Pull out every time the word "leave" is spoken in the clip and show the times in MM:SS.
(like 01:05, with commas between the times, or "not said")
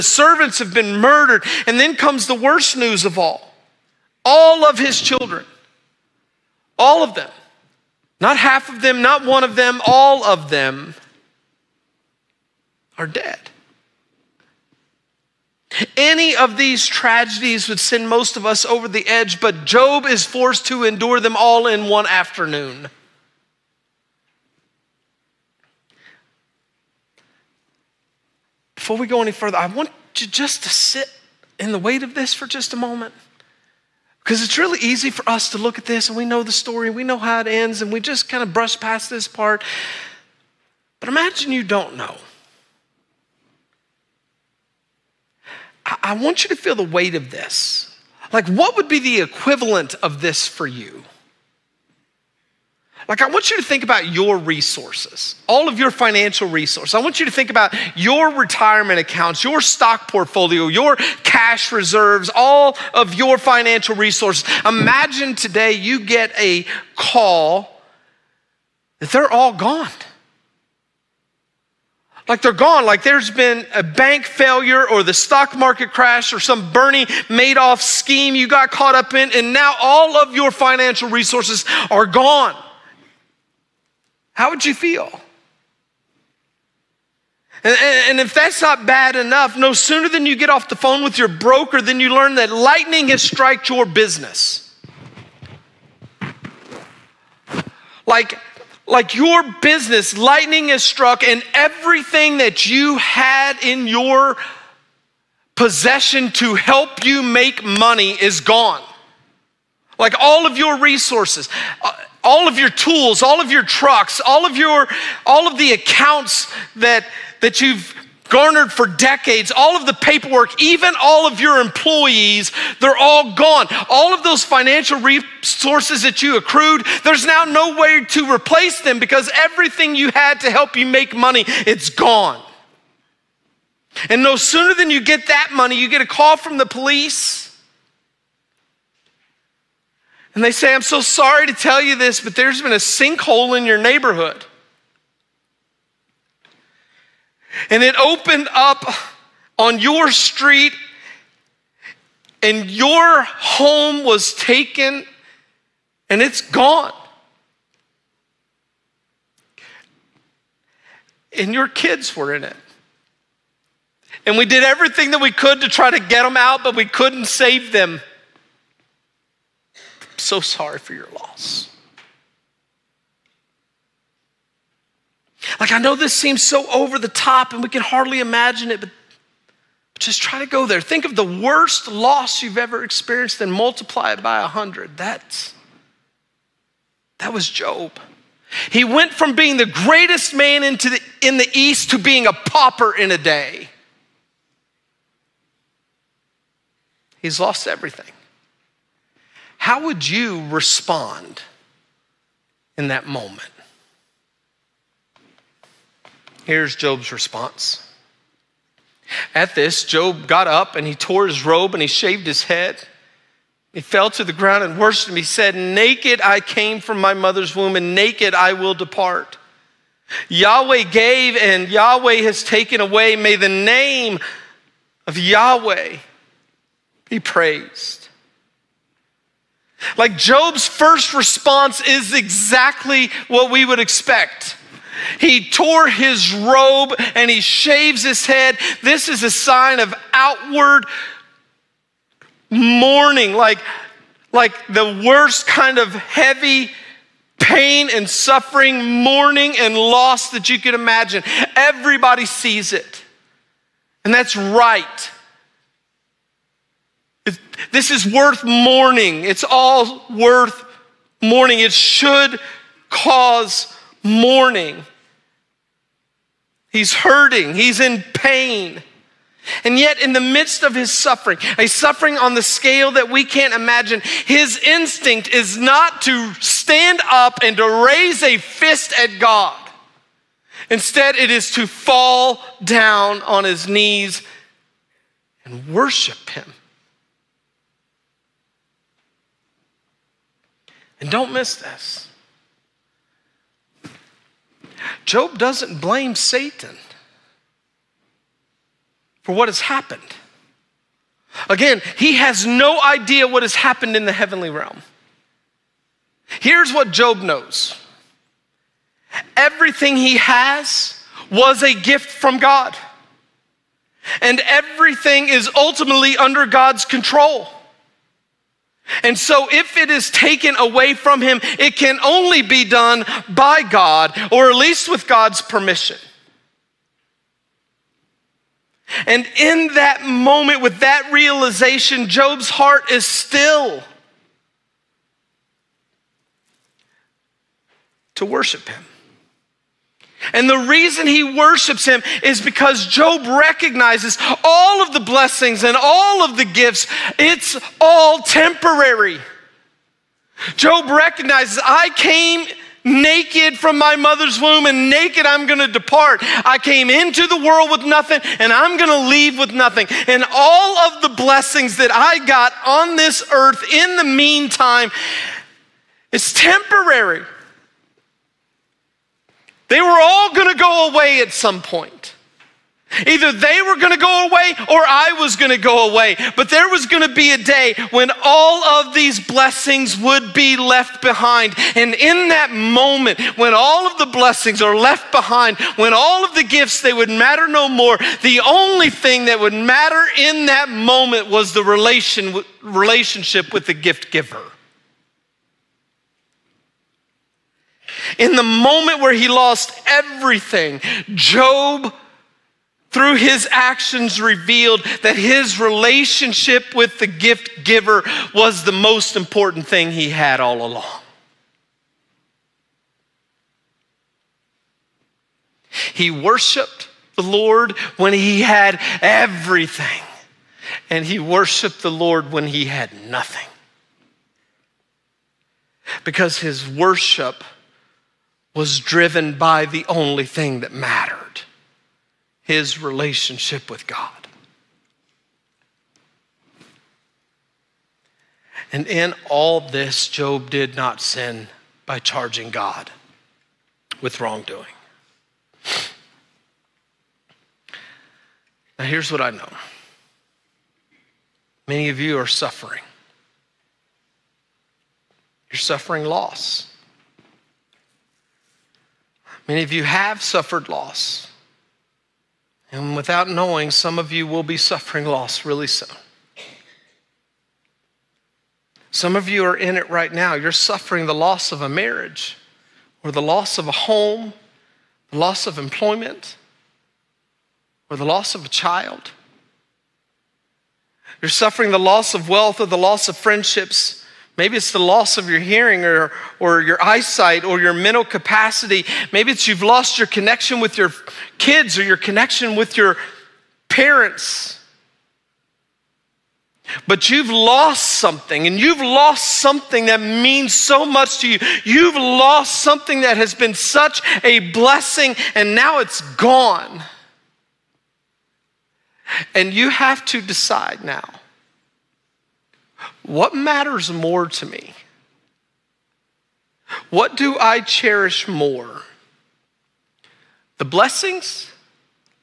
05:59.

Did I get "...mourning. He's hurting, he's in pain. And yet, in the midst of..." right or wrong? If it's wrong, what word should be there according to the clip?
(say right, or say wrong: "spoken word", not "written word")
right.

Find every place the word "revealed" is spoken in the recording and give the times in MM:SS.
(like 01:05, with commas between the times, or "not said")
06:44.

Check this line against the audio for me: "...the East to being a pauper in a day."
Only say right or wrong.
right.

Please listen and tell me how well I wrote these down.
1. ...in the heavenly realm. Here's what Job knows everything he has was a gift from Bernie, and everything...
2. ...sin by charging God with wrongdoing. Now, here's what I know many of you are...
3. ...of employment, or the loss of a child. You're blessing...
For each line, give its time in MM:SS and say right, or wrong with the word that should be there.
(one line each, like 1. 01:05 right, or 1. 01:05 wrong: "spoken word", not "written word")
1. 05:03 wrong: "God", not "Bernie"
2. 07:21 right
3. 07:55 wrong: "suffering", not "blessing".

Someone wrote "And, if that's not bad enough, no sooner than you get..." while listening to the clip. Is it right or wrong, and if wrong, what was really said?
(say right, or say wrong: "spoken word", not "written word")
right.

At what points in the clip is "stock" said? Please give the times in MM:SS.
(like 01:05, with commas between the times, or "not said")
00:59, 01:15.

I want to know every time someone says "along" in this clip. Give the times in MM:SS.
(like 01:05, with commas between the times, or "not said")
06:50.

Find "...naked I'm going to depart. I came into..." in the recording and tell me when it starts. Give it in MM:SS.
05:54.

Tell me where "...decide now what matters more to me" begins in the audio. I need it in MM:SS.
08:30.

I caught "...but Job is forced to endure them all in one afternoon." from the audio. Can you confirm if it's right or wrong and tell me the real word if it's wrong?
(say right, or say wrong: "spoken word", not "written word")
right.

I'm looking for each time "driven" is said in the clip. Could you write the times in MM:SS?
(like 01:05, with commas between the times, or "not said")
07:08.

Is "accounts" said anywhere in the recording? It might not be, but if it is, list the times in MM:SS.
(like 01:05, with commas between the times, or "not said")
00:58, 01:55.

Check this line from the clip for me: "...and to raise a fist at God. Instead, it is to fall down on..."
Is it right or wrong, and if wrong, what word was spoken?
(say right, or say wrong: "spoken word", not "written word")
right.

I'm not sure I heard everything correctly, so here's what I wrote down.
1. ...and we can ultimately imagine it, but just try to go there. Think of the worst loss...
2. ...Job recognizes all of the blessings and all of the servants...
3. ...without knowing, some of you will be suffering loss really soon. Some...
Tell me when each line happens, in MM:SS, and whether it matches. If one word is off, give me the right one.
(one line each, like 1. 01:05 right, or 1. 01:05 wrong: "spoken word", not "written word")
1. 02:57 wrong: "hardly", not "ultimately"
2. 05:42 wrong: "gifts", not "servants"
3. 07:42 right.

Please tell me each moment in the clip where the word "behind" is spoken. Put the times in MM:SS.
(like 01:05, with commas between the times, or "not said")
06:21, 06:25.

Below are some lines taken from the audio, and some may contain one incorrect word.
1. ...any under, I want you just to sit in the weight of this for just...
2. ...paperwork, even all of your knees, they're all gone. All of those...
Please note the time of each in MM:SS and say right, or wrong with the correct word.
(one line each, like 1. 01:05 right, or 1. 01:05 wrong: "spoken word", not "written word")
1. 00:29 wrong: "further", not "under"
2. 01:59 wrong: "employees", not "knees".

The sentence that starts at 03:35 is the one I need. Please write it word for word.
He said, Naked I came from my mother's womb, and naked I will depart.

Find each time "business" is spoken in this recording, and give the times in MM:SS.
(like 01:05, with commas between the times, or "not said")
01:33, 01:39.